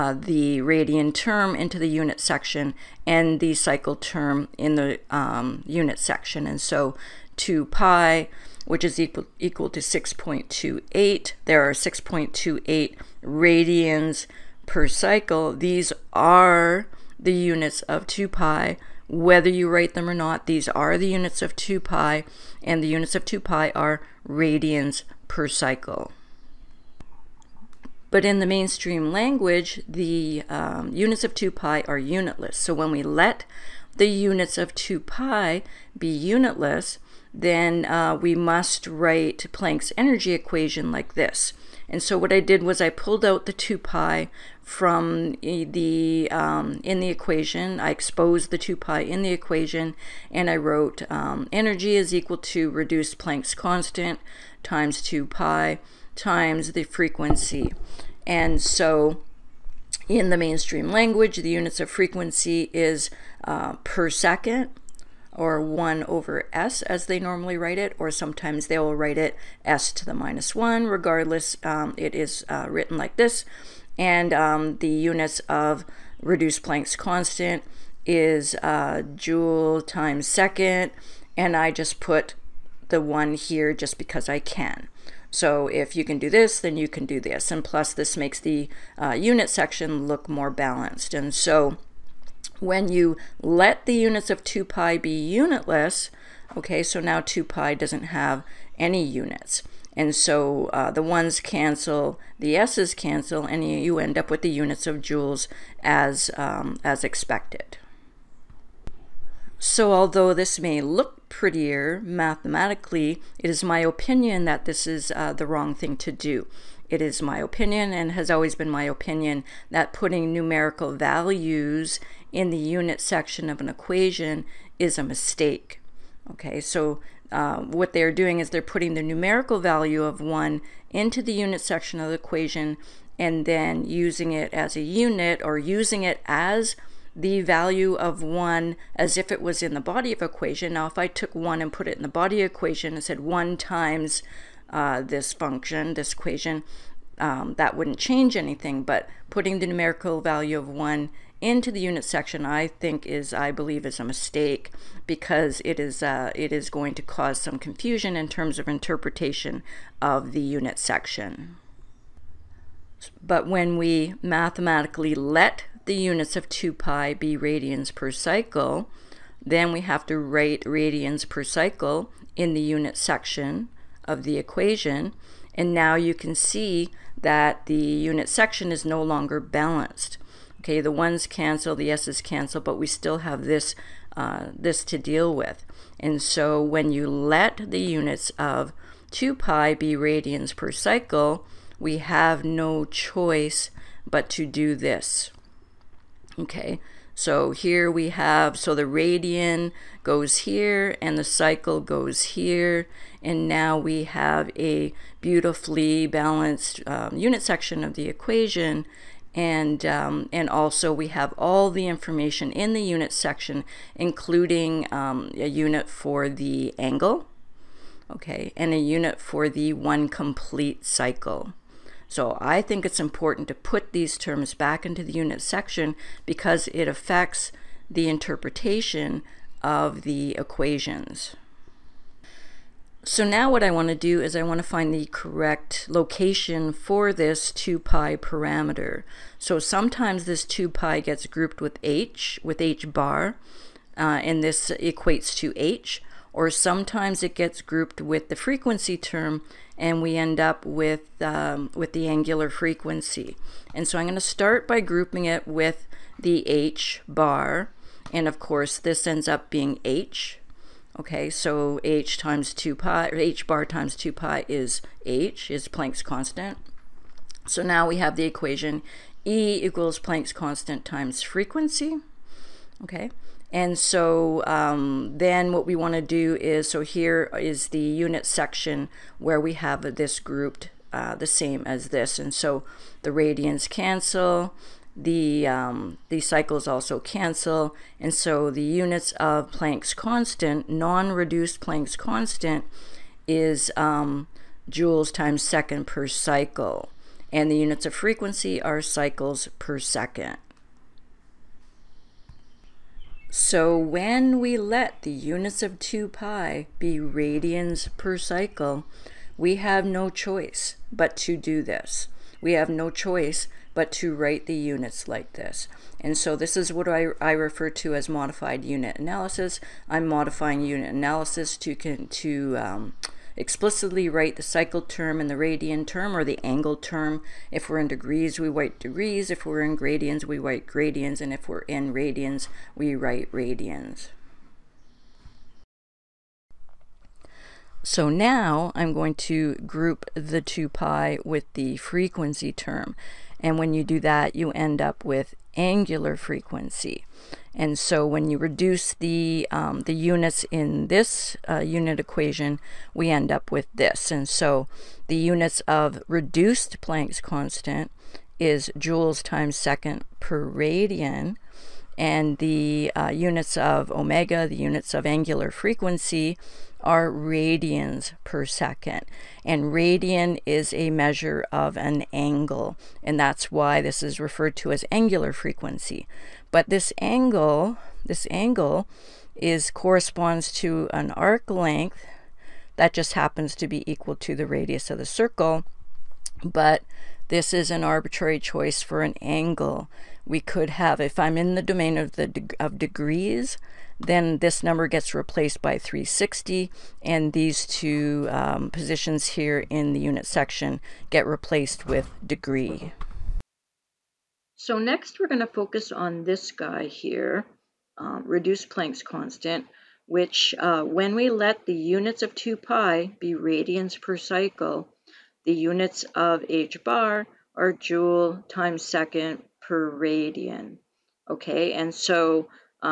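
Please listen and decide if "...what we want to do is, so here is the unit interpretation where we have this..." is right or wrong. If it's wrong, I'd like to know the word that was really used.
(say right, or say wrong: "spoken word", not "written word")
wrong: "section", not "interpretation".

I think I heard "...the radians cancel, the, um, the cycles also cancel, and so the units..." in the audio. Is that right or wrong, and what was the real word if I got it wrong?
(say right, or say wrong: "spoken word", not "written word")
right.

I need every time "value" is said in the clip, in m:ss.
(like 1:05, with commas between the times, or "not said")
2:00, 2:09, 2:17, 2:30.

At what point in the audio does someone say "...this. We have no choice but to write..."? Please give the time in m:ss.
5:11.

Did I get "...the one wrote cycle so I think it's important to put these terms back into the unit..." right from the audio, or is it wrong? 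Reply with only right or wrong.
wrong.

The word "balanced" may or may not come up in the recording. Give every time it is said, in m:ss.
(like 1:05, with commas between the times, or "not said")
1:30, 2:59, 3:26.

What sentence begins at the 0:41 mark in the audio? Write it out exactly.
And so what I did was I pulled out the 2 pi from eh, the um, in the equation.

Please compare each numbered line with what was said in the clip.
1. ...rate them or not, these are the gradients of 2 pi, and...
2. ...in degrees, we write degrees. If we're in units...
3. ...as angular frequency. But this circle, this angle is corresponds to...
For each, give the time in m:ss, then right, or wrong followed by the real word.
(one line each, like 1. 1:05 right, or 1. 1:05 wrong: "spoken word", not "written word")
1. 0:19 wrong: "units", not "gradients"
2. 5:27 wrong: "gradients", not "units"
3. 6:14 wrong: "angle", not "circle".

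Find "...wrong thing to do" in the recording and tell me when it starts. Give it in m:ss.
1:55.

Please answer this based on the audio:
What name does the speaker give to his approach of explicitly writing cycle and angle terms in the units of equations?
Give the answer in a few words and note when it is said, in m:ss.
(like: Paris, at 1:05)
modified unit analysis, at 5:18.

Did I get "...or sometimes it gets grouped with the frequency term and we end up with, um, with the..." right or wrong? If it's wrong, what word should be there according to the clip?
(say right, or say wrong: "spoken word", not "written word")
right.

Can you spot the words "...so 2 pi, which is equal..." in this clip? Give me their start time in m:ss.
0:06.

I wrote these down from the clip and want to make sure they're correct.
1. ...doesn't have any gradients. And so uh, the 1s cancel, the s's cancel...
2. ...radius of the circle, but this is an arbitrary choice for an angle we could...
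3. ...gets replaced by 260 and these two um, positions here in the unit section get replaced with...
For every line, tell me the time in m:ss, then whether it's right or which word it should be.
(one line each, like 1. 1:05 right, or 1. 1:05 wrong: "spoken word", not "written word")
1. 1:37 wrong: "units", not "gradients"
2. 6:24 right
3. 6:34 wrong: "360", not "260".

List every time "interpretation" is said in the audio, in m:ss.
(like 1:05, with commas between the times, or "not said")
2:38, 3:48.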